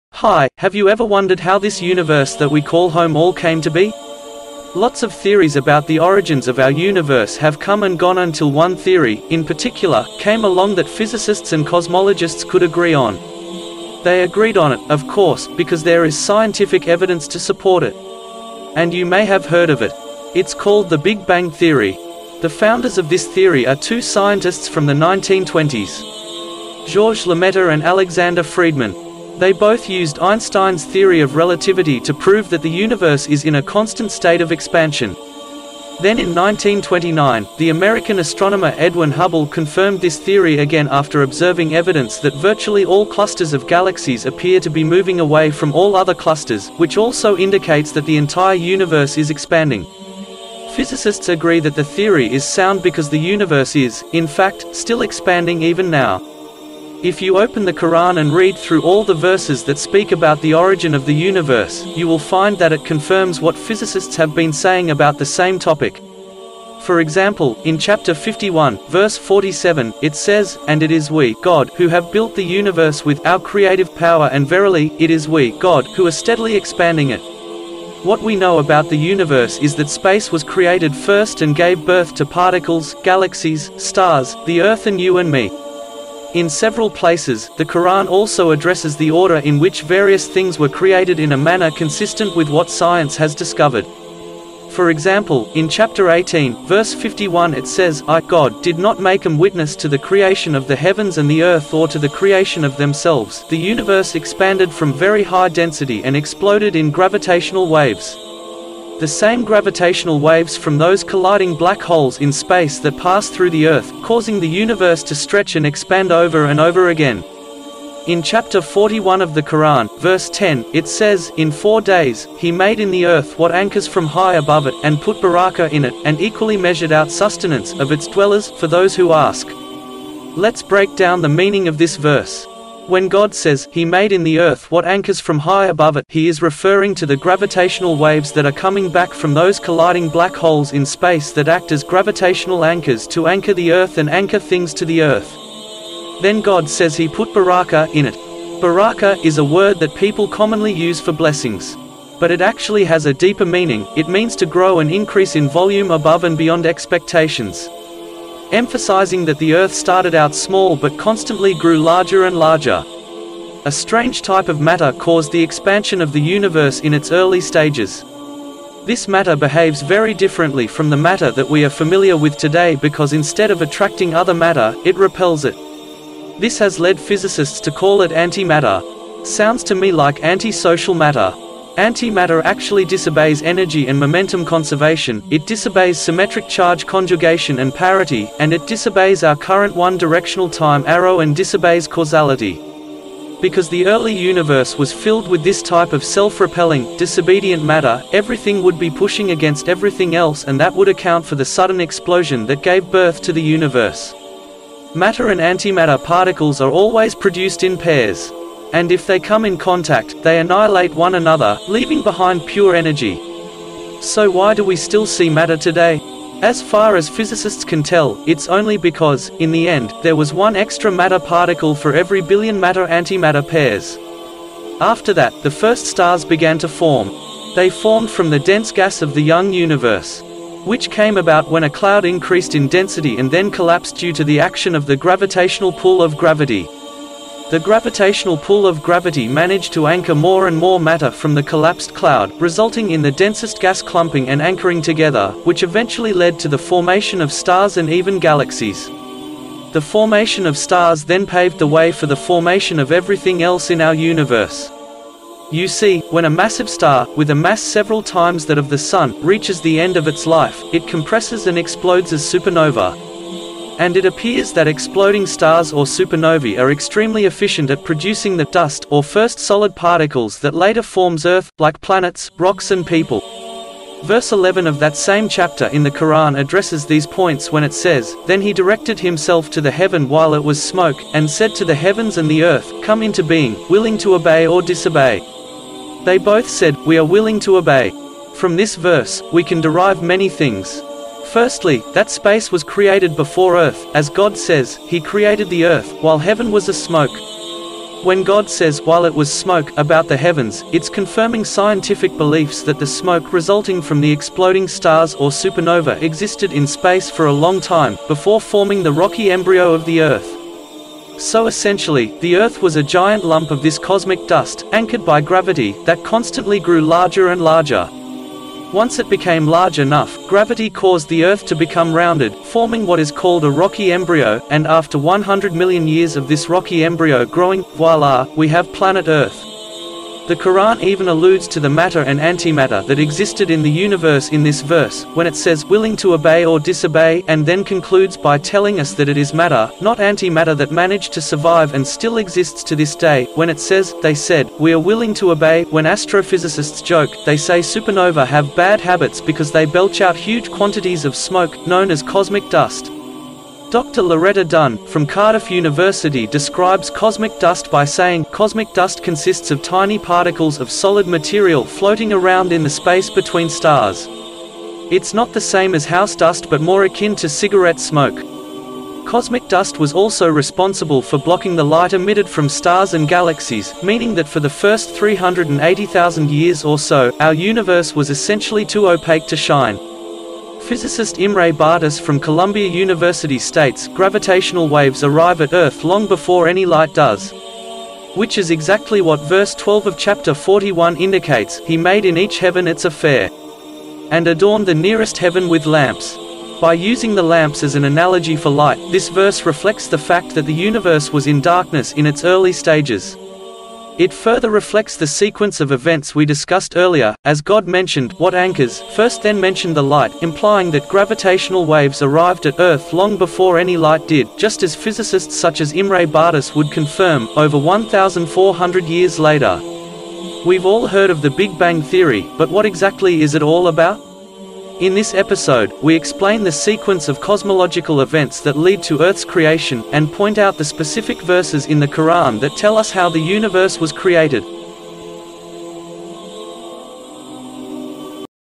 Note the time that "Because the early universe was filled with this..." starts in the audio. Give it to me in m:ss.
3:13.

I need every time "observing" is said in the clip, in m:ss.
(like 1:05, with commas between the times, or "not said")
0:41.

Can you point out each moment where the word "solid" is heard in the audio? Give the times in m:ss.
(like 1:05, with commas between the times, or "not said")
4:29, 6:00.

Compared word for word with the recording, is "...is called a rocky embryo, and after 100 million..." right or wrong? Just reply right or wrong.
right.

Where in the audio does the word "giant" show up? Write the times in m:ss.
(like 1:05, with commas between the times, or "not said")
5:12.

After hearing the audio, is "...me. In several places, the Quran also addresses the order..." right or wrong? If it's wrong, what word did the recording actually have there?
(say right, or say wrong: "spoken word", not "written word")
right.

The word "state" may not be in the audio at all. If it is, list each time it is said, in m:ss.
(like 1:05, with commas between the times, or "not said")
0:34, 6:23.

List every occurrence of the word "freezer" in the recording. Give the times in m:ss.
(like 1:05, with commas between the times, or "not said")
not said.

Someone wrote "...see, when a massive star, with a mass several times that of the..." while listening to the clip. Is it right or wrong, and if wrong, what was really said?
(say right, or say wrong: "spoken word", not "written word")
right.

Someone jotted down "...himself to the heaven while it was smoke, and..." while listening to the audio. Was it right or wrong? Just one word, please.
right.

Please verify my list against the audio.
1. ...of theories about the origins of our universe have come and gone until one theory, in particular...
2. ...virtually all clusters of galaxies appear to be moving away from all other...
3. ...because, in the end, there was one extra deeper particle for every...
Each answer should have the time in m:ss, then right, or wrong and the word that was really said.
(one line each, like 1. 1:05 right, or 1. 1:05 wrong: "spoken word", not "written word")
1. 0:05 right
2. 0:42 right
3. 3:38 wrong: "matter", not "deeper".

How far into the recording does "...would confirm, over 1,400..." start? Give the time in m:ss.
6:56.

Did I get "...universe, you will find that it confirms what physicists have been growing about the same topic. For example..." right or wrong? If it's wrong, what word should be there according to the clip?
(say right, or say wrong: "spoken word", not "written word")
wrong: "saying", not "growing".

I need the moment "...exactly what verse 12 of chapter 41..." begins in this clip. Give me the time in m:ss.
6:28.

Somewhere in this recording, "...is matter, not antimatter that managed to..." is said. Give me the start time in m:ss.
5:39.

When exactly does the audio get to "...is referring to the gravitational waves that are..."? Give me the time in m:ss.
2:16.